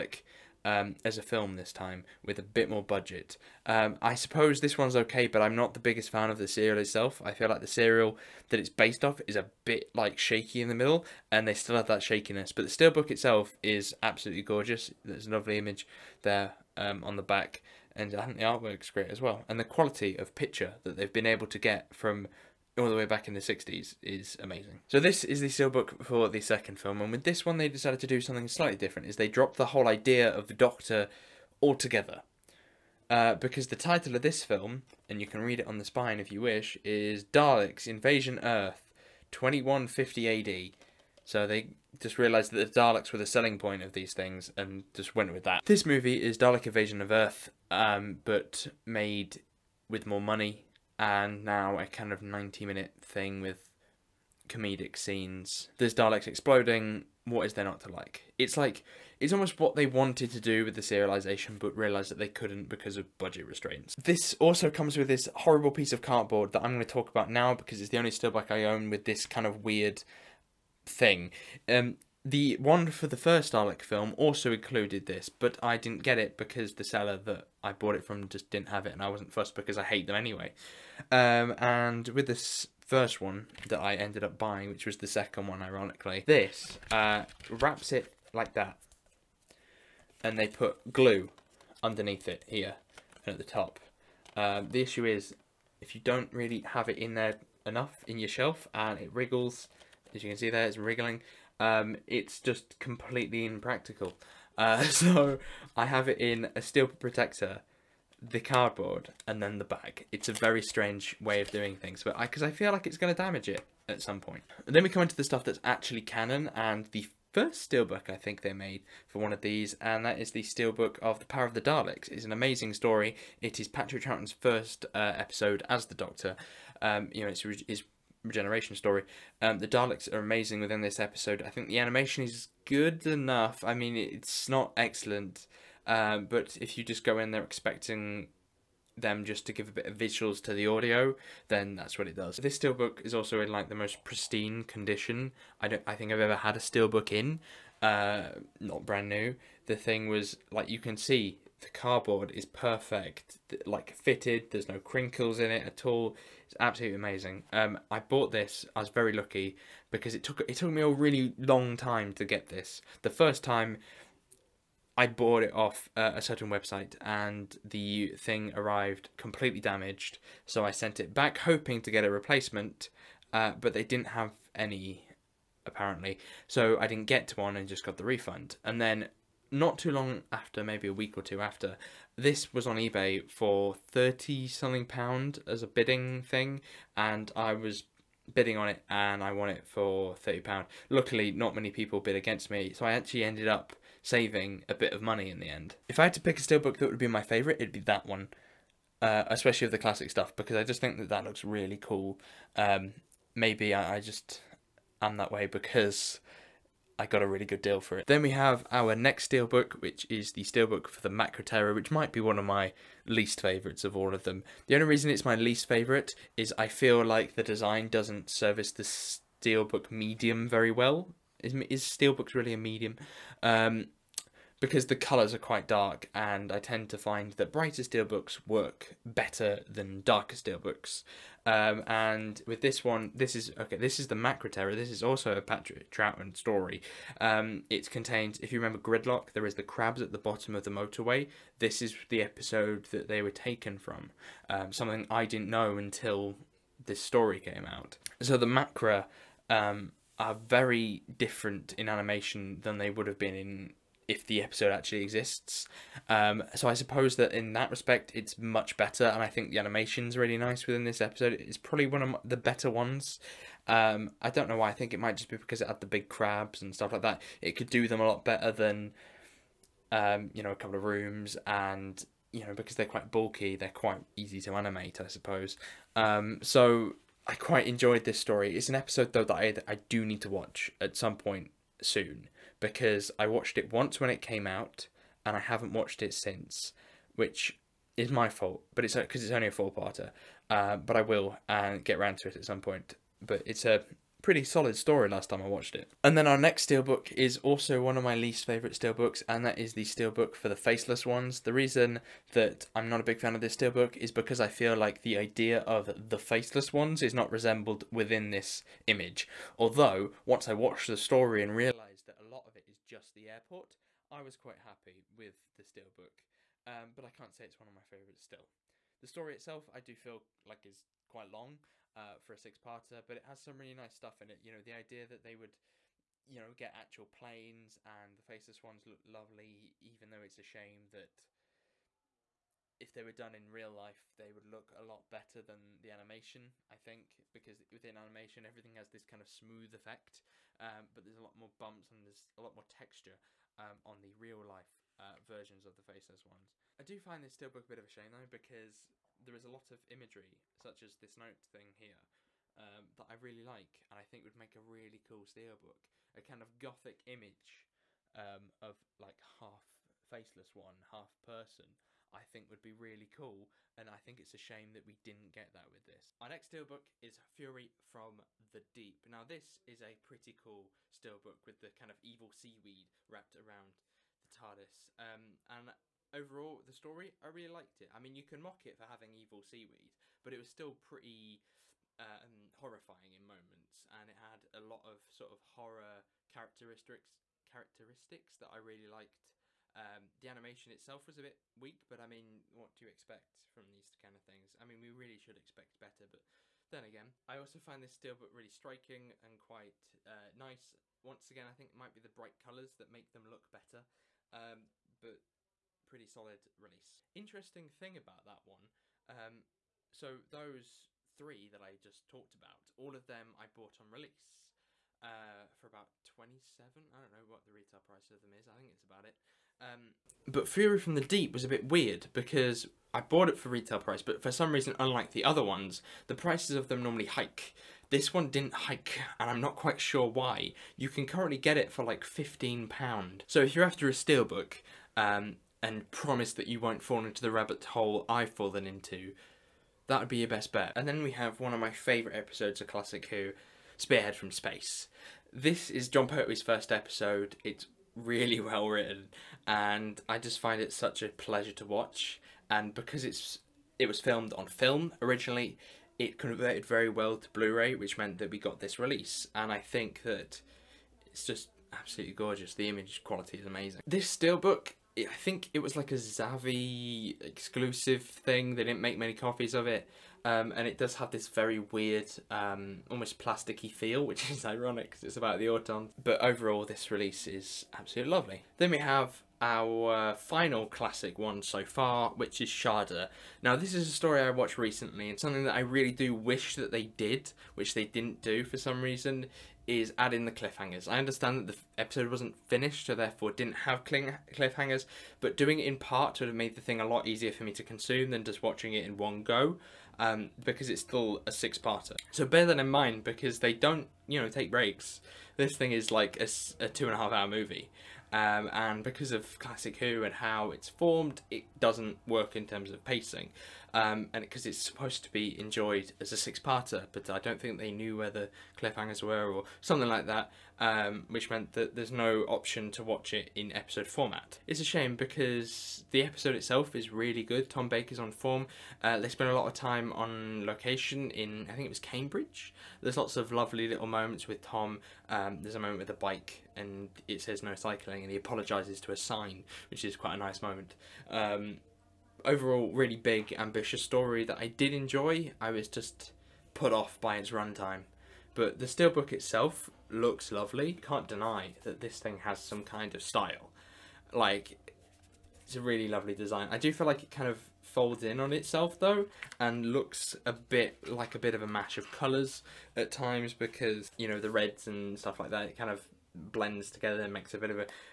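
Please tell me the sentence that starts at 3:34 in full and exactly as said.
The only reason it's my least favourite is I feel like the design doesn't service the steelbook medium very well.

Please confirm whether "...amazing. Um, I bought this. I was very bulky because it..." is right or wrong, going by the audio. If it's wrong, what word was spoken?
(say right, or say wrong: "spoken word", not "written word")
wrong: "lucky", not "bulky".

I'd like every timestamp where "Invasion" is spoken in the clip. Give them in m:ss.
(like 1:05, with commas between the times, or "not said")
0:37, 0:46.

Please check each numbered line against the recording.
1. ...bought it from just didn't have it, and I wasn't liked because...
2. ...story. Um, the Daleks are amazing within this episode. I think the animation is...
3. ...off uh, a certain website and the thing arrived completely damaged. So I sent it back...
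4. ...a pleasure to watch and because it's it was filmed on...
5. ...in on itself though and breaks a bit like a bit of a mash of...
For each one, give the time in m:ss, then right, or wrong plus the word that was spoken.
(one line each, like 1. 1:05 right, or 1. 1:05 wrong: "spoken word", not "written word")
1. 1:17 wrong: "fussed", not "liked"
2. 2:08 right
3. 2:45 right
4. 7:31 right
5. 9:18 wrong: "looks", not "breaks".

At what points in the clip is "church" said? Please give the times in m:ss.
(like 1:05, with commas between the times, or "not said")
not said.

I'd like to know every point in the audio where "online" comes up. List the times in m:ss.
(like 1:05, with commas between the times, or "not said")
not said.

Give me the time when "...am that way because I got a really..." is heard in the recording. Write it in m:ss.
3:24.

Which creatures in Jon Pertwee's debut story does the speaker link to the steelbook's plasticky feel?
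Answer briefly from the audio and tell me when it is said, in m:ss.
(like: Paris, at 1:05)
The Auton, at 7:55.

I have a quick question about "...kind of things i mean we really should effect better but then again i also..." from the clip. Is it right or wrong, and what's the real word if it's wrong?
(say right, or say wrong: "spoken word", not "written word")
wrong: "expect", not "effect".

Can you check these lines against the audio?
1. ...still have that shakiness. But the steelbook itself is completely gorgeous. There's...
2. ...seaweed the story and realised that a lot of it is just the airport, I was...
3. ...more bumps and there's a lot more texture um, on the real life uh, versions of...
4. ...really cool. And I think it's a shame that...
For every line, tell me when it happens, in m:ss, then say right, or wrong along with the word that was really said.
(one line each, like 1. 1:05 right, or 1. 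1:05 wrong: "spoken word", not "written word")
1. 0:11 wrong: "absolutely", not "completely"
2. 5:10 wrong: "watched", not "seaweed"
3. 5:41 right
4. 6:02 right.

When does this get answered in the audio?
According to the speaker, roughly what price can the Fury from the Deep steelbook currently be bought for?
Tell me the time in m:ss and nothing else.
7:12.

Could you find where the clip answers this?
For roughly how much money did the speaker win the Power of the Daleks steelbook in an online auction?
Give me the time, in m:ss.
3:10.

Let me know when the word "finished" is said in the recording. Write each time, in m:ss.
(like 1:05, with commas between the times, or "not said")
8:12.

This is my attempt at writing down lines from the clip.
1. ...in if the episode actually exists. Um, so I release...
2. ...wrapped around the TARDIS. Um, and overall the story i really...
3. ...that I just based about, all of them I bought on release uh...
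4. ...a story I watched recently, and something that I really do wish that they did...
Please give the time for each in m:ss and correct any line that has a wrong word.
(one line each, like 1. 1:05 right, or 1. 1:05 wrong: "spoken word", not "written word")
1. 4:13 wrong: "suppose", not "release"
2. 6:13 right
3. 6:51 wrong: "talked", not "based"
4. 8:03 right.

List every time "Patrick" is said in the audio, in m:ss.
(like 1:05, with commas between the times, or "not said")
2:03, 3:55.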